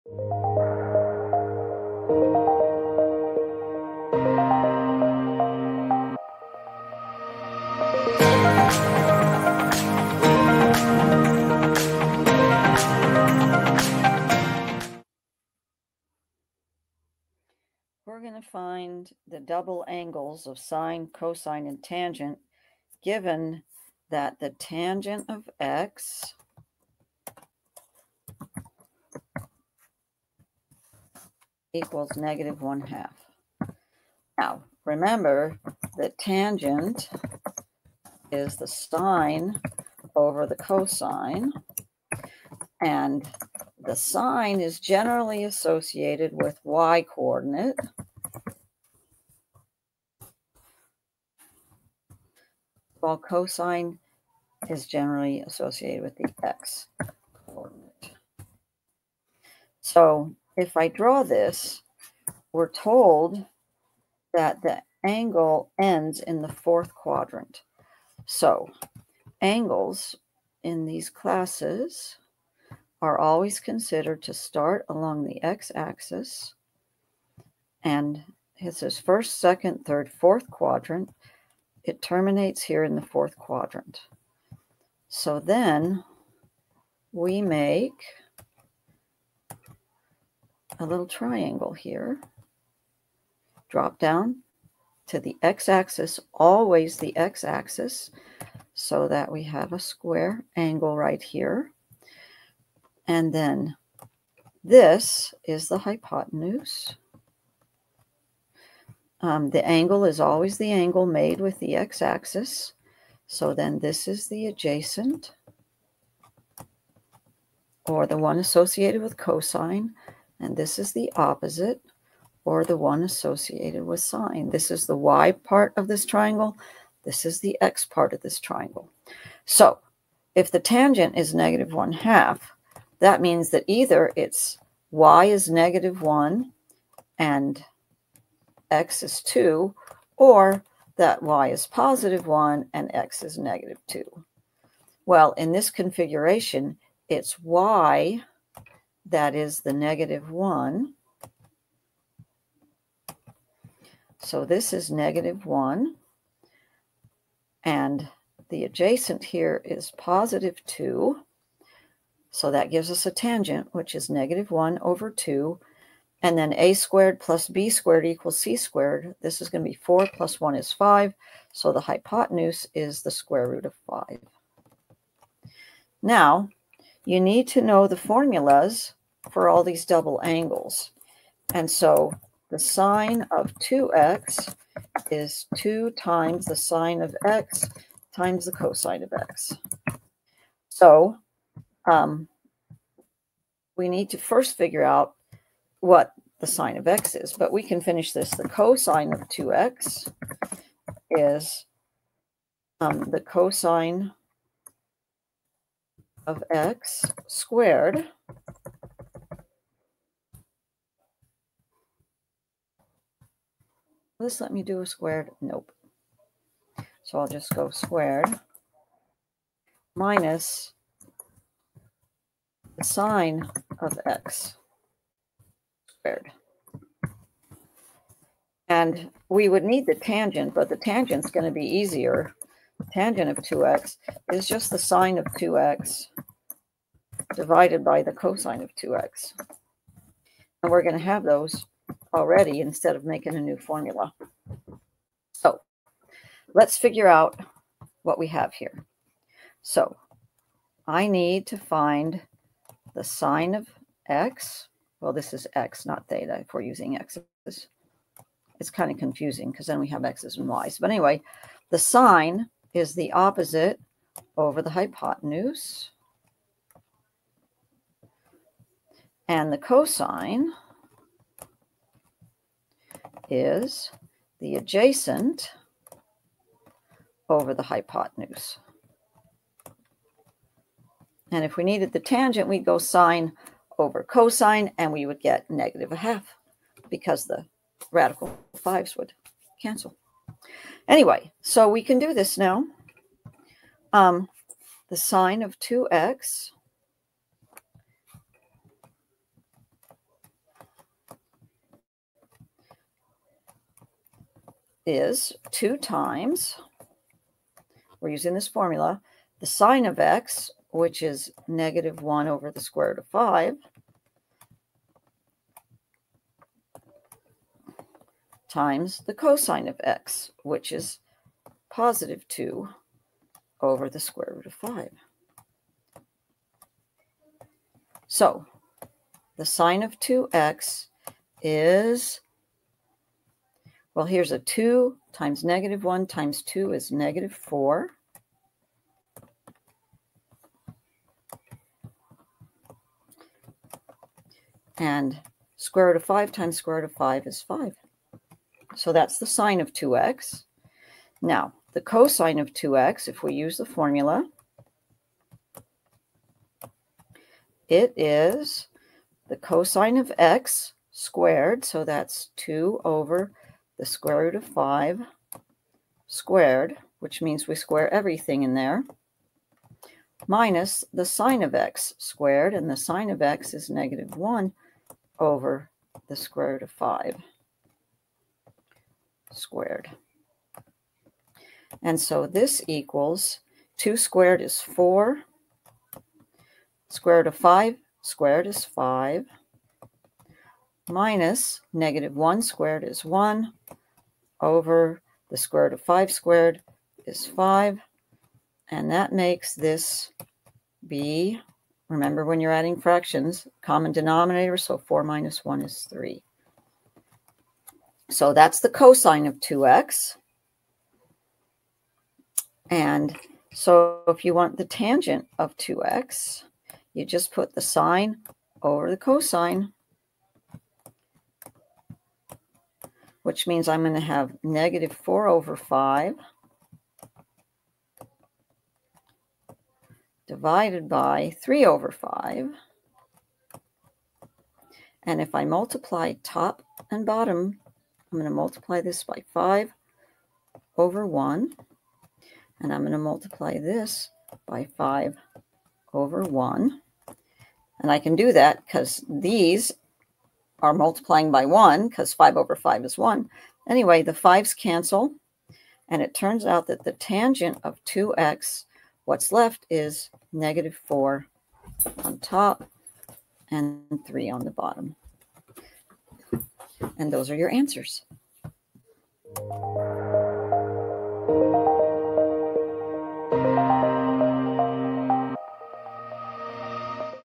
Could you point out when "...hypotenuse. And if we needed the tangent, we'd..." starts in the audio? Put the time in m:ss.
4:37.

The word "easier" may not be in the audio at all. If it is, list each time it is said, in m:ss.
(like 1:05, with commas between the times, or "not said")
3:51.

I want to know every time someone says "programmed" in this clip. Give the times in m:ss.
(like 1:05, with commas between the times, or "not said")
not said.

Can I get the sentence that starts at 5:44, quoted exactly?
And square root of 5 times square root of 5 is 5.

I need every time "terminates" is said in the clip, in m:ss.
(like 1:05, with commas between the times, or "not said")
1:22.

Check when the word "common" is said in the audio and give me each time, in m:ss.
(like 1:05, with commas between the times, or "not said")
6:43.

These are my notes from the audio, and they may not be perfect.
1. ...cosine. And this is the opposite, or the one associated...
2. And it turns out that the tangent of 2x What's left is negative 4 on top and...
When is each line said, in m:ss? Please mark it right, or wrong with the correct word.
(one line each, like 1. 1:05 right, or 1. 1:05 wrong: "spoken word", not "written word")
1. 1:59 right
2. 7:35 right.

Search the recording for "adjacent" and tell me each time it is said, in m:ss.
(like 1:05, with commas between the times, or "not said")
1:54, 2:38, 4:34.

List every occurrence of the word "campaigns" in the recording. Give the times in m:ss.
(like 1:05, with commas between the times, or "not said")
not said.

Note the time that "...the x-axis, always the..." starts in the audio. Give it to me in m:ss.
1:35.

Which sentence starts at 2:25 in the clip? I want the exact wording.
Well, in this configuration, it's y that is the negative 1.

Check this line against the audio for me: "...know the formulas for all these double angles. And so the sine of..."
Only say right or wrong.
right.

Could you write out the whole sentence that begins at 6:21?
And so this equals 2 squared is 4.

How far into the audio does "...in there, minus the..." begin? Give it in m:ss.
6:08.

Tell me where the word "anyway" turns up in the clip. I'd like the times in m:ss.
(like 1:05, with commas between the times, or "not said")
4:20, 4:50, 7:33.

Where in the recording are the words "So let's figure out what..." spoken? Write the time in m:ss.
4:05.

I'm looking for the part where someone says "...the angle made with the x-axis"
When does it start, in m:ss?
1:50.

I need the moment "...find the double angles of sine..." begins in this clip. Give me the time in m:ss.
0:18.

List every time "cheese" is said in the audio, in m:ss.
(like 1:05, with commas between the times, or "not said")
not said.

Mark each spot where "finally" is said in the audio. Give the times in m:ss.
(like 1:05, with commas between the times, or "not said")
not said.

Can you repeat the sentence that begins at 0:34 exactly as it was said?
Now, remember that tangent is the sine over the cosine, and the sine is generally associated with y coordinate.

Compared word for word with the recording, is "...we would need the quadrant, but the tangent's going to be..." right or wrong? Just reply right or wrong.
wrong.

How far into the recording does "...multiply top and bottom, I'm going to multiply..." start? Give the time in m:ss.
7:15.